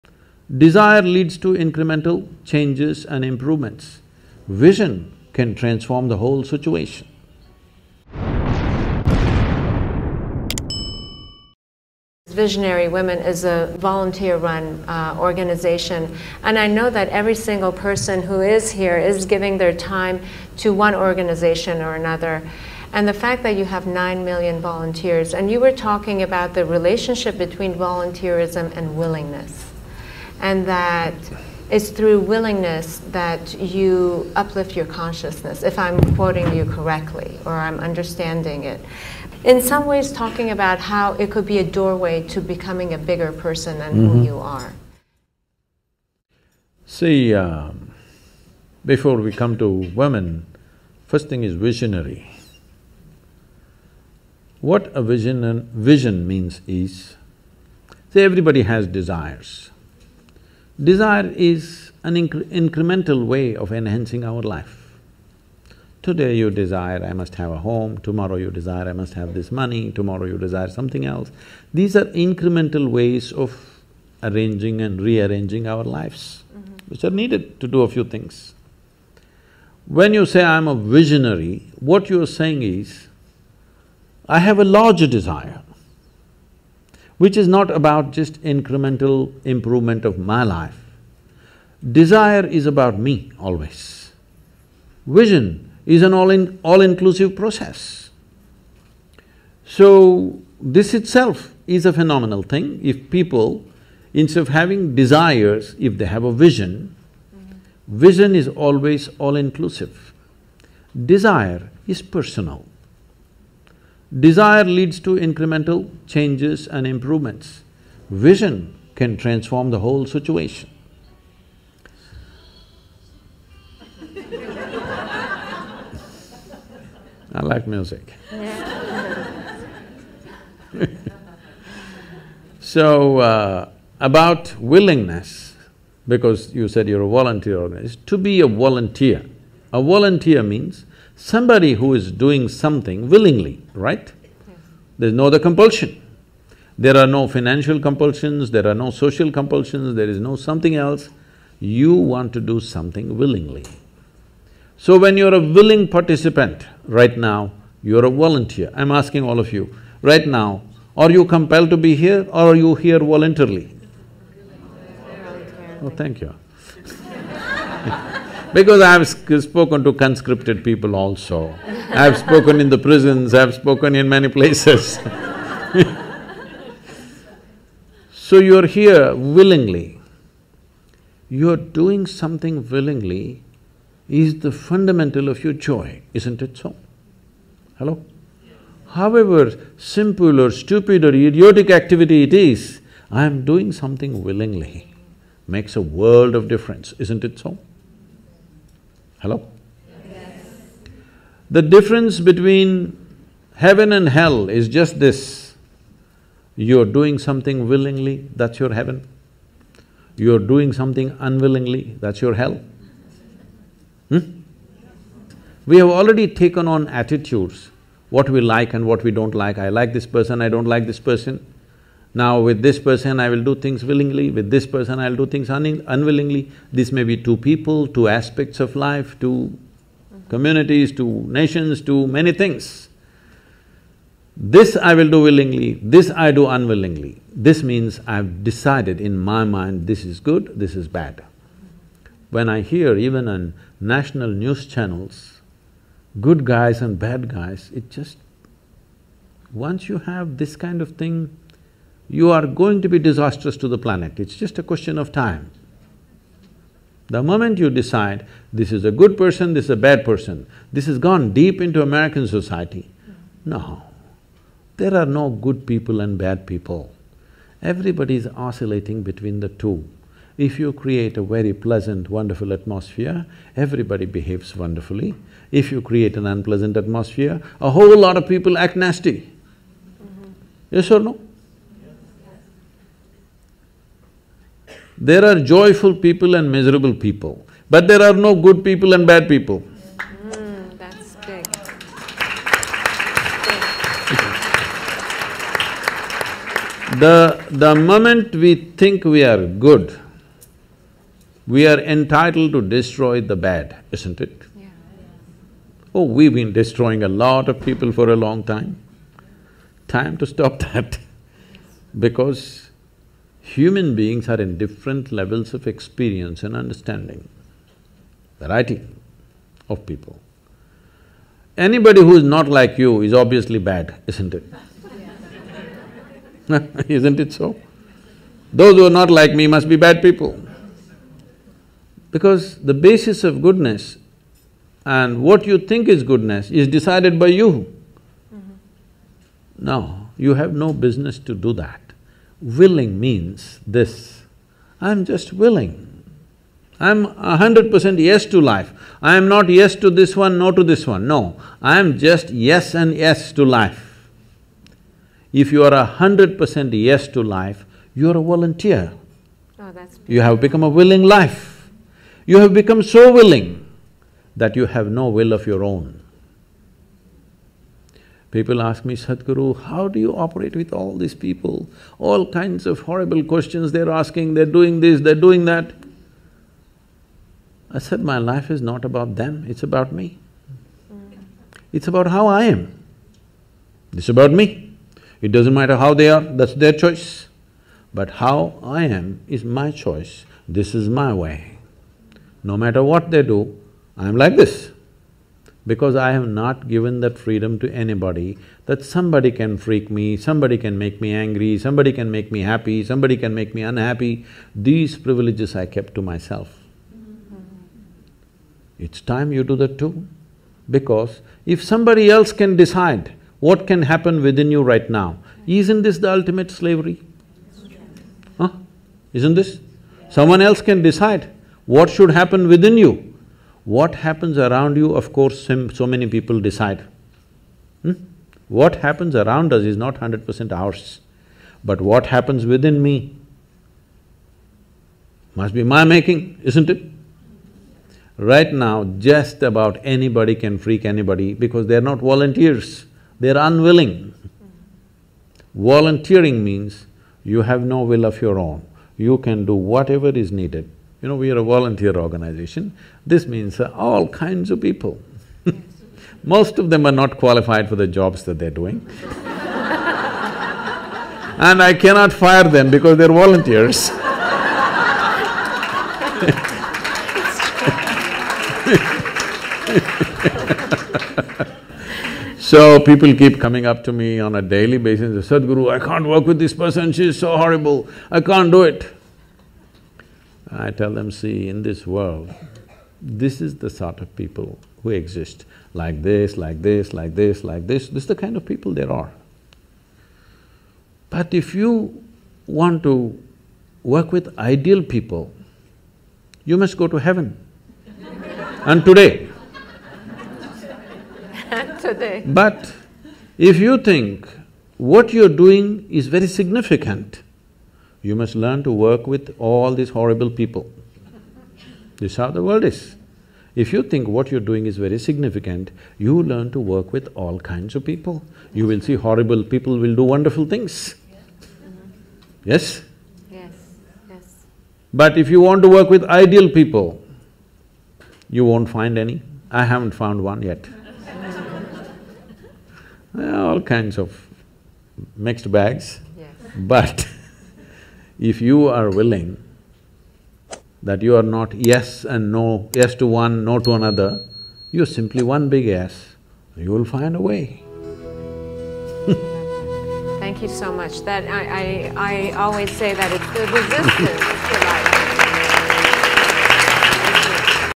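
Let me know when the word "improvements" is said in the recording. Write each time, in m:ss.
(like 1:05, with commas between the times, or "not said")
0:03, 1:29, 1:56.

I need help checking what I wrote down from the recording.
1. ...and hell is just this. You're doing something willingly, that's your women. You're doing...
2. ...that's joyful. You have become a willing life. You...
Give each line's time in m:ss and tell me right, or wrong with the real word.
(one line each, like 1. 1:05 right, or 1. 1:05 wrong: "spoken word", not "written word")
1. 3:23 wrong: "heaven", not "women"
2. 5:59 wrong: "beautiful", not "joyful".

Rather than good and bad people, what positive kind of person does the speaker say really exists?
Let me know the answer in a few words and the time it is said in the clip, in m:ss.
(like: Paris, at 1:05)
joyful people, at 4:45.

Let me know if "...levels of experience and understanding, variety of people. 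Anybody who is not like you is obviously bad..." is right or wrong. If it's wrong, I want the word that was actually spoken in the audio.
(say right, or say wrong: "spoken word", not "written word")
right.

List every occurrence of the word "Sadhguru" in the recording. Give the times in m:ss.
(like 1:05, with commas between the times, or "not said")
6:08, 7:55.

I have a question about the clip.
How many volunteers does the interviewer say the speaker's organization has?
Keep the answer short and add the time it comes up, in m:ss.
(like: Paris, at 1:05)
9 million, at 0:23.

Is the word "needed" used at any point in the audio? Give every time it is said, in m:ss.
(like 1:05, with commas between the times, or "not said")
1:17, 7:30.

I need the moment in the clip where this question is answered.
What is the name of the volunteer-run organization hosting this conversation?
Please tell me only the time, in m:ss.
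0:12.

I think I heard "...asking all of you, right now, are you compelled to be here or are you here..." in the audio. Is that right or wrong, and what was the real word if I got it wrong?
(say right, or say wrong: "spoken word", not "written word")
right.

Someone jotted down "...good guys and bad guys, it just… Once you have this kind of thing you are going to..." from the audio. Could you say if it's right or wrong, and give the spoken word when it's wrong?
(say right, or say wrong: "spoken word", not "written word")
right.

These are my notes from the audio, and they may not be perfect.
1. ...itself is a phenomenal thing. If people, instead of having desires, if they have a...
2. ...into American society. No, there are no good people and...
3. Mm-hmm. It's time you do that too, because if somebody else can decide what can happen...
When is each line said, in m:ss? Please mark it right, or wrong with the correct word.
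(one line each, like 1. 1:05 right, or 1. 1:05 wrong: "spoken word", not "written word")
1. 1:41 right
2. 4:21 right
3. 6:46 right.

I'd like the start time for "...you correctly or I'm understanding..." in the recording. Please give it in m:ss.
0:36.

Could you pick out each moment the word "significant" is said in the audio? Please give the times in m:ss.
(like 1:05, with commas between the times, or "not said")
8:26, 8:34.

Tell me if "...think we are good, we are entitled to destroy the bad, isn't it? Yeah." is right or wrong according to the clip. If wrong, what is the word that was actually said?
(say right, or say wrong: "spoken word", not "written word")
right.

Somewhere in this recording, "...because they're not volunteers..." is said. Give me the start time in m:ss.
7:21.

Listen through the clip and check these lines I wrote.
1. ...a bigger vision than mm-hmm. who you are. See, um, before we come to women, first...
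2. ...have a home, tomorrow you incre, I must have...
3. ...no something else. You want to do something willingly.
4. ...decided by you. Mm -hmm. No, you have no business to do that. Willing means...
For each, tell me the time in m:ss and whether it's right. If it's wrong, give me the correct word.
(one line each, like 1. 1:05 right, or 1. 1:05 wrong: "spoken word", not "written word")
1. 0:42 wrong: "person", not "vision"
2. 1:07 wrong: "desire", not "incre"
3. 2:30 right
4. 5:36 right.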